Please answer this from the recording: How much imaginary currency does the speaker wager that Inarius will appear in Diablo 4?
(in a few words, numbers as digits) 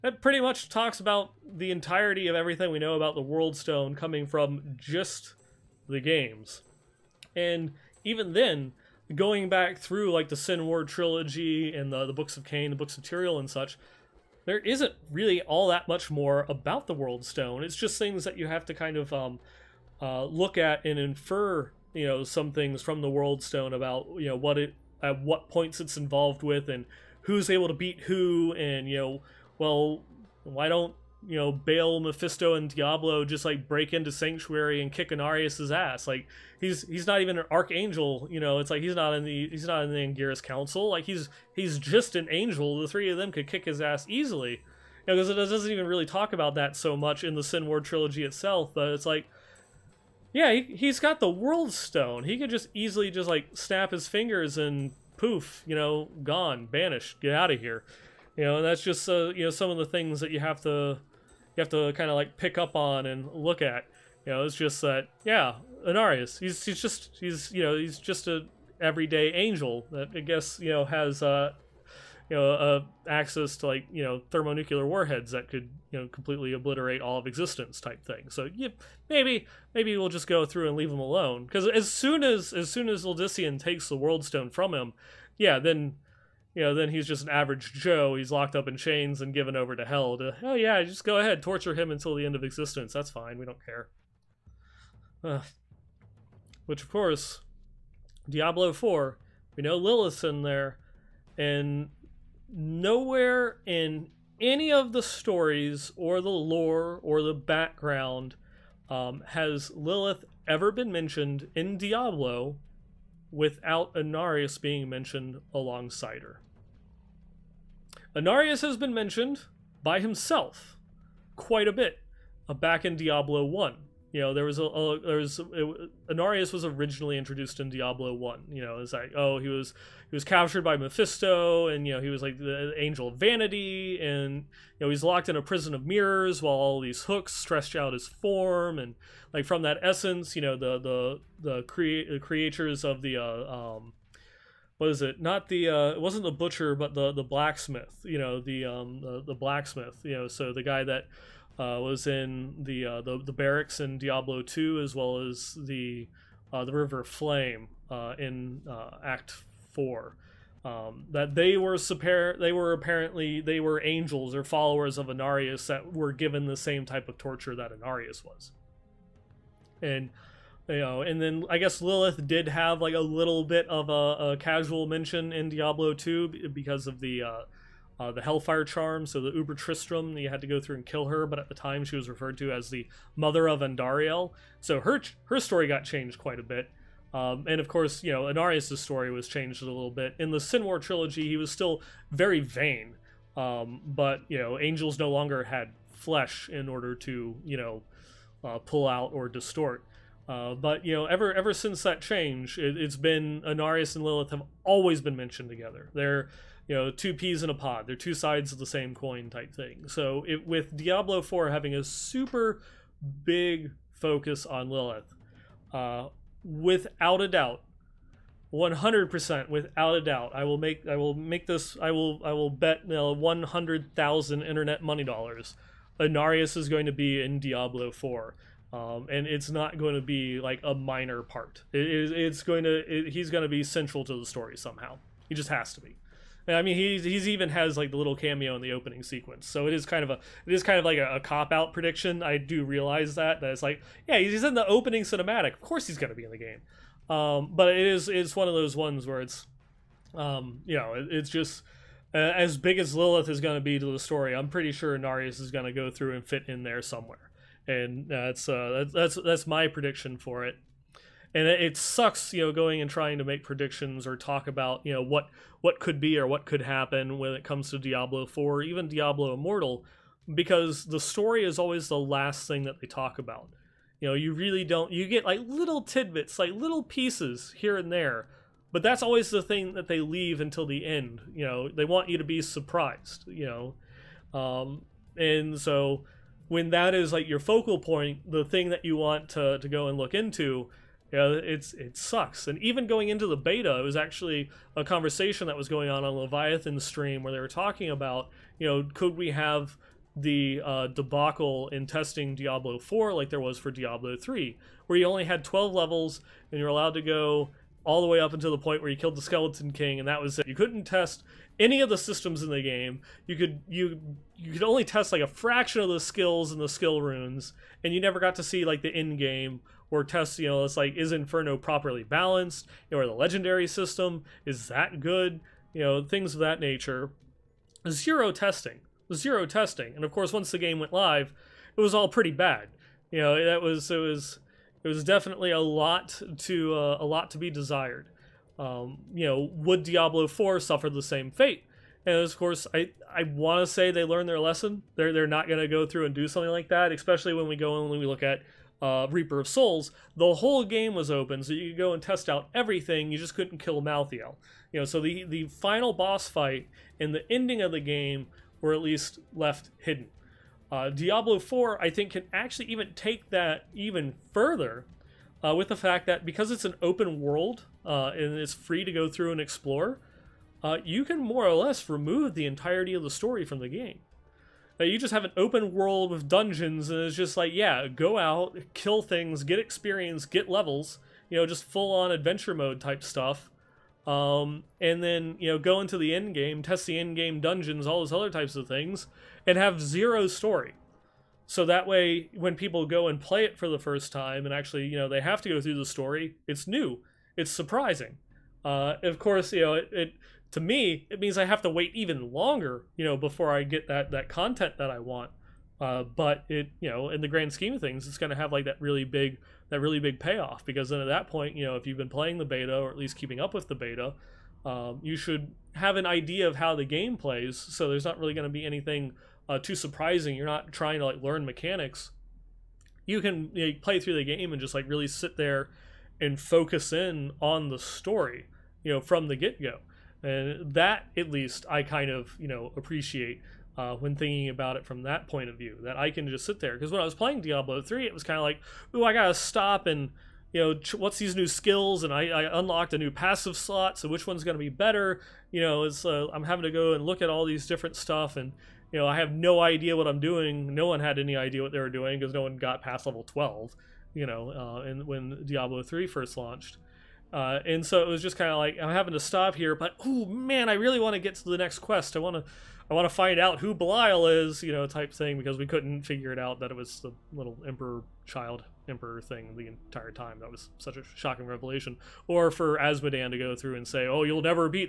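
100000 internet money dollars.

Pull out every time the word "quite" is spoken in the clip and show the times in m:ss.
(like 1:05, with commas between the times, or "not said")
2:01, 3:06.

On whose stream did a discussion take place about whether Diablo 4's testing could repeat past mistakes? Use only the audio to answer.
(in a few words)
Leviathan.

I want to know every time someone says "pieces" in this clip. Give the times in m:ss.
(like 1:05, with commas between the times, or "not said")
4:36.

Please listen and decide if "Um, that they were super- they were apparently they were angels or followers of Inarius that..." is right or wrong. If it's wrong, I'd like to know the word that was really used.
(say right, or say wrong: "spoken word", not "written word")
right.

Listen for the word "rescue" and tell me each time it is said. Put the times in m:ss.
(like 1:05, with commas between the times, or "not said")
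not said.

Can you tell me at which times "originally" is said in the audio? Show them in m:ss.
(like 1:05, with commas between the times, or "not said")
2:06.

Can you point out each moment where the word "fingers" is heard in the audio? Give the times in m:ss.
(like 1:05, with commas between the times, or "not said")
0:54.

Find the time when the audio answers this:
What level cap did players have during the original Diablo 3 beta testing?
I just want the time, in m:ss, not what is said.
5:05.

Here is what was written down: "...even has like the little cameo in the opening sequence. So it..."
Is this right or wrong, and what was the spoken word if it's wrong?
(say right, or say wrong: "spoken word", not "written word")
right.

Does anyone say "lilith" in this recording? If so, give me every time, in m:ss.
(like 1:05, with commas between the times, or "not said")
1:39, 1:49, 2:51, 3:24, 3:34, 4:12.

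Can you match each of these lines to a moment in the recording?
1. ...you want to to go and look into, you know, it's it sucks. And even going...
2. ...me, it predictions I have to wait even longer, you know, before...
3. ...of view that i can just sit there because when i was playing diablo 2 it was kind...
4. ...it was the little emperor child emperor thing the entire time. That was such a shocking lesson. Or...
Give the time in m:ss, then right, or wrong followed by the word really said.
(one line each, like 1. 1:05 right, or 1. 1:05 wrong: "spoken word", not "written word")
1. 4:48 right
2. 6:40 wrong: "means", not "predictions"
3. 7:15 wrong: "3", not "2"
4. 7:46 wrong: "revelation", not "lesson".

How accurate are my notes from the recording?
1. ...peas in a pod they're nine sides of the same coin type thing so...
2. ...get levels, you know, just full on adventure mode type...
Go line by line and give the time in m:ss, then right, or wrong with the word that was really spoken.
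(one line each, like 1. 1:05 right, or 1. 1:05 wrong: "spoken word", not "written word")
1. 3:27 wrong: "two", not "nine"
2. 6:20 right.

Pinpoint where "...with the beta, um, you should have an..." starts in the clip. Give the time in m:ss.
6:53.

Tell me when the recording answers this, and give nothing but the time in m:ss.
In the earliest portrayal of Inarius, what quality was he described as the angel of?
2:12.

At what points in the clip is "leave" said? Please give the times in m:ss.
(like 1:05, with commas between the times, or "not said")
1:20, 4:39.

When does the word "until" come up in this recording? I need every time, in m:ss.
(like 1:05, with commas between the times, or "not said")
1:31, 4:40, 5:08.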